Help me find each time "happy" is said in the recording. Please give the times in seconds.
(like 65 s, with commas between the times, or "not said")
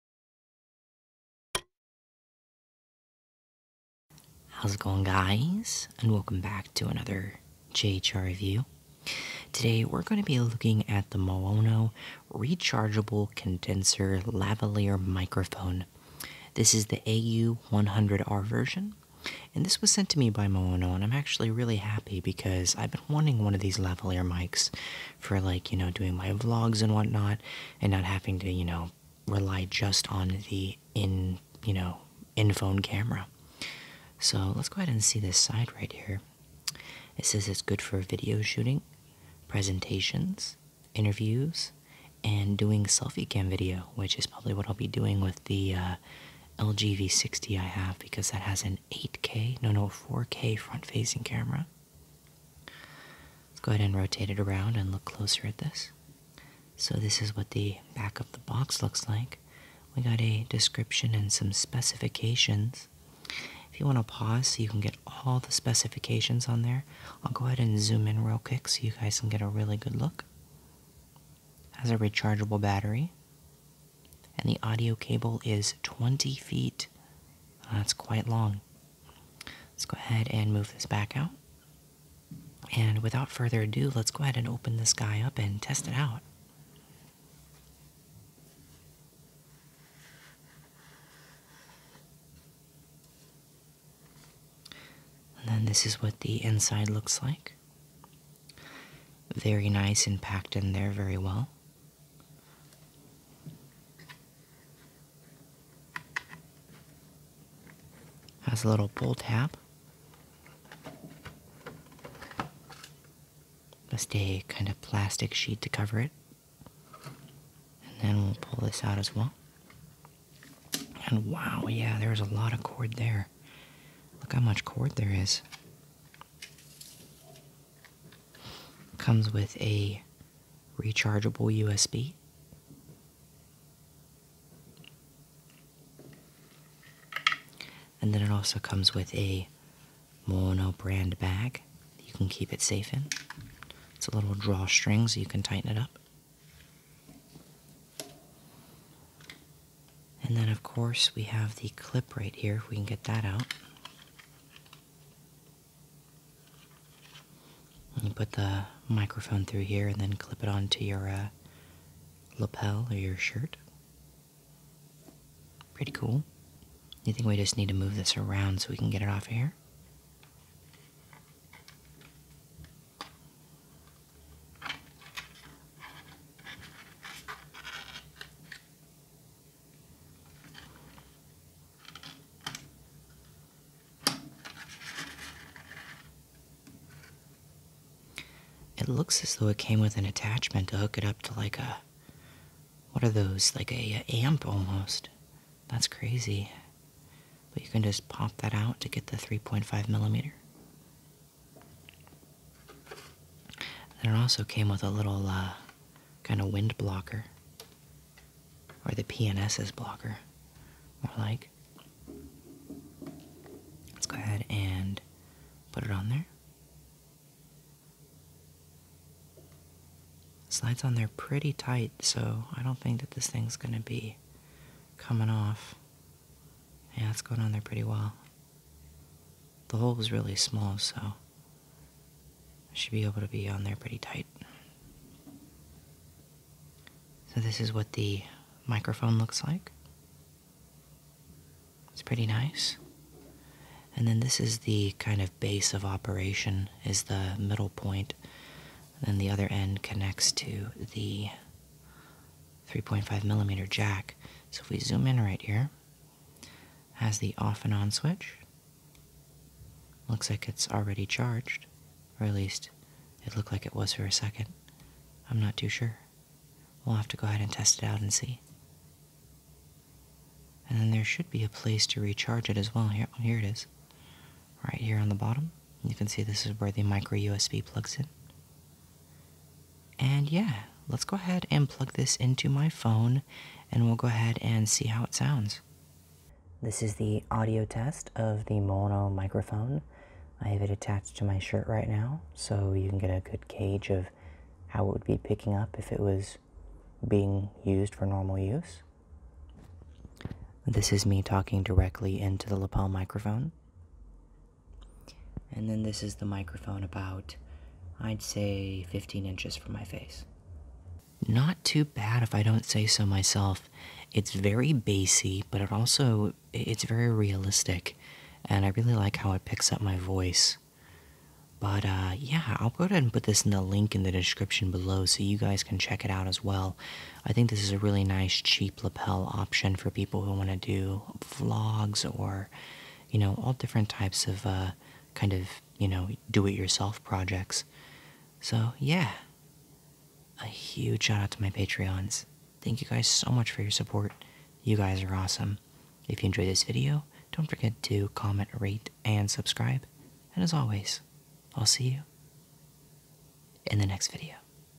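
21 s.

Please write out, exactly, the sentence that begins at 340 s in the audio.
A huge shout out to my Patreons.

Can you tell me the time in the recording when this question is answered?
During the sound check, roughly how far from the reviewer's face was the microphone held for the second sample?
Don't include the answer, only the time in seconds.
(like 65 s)
308 s.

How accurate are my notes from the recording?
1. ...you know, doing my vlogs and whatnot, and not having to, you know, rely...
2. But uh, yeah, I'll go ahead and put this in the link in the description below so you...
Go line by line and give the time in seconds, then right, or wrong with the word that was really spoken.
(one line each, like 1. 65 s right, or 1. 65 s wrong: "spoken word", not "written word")
1. 25 s right
2. 321 s right.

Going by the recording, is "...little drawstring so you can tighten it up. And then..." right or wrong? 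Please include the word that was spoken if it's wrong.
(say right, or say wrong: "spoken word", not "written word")
right.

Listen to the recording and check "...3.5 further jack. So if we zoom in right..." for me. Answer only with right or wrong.
wrong.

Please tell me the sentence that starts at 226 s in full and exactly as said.
Yeah, it's going on there pretty well.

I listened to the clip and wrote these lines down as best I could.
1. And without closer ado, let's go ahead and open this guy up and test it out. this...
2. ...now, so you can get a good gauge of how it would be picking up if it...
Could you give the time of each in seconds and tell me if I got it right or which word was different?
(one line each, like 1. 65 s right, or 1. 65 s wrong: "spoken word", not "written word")
1. 82 s wrong: "further", not "closer"
2. 291 s right.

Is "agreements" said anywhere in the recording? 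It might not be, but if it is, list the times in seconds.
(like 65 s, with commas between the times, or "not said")
not said.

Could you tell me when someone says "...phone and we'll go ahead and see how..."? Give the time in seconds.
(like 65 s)
282 s.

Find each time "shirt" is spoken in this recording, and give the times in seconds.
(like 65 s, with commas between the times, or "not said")
163 s, 291 s.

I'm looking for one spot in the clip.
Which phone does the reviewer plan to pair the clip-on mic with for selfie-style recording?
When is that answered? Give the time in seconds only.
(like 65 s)
46 s.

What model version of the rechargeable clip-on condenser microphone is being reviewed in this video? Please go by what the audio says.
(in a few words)
AU100R.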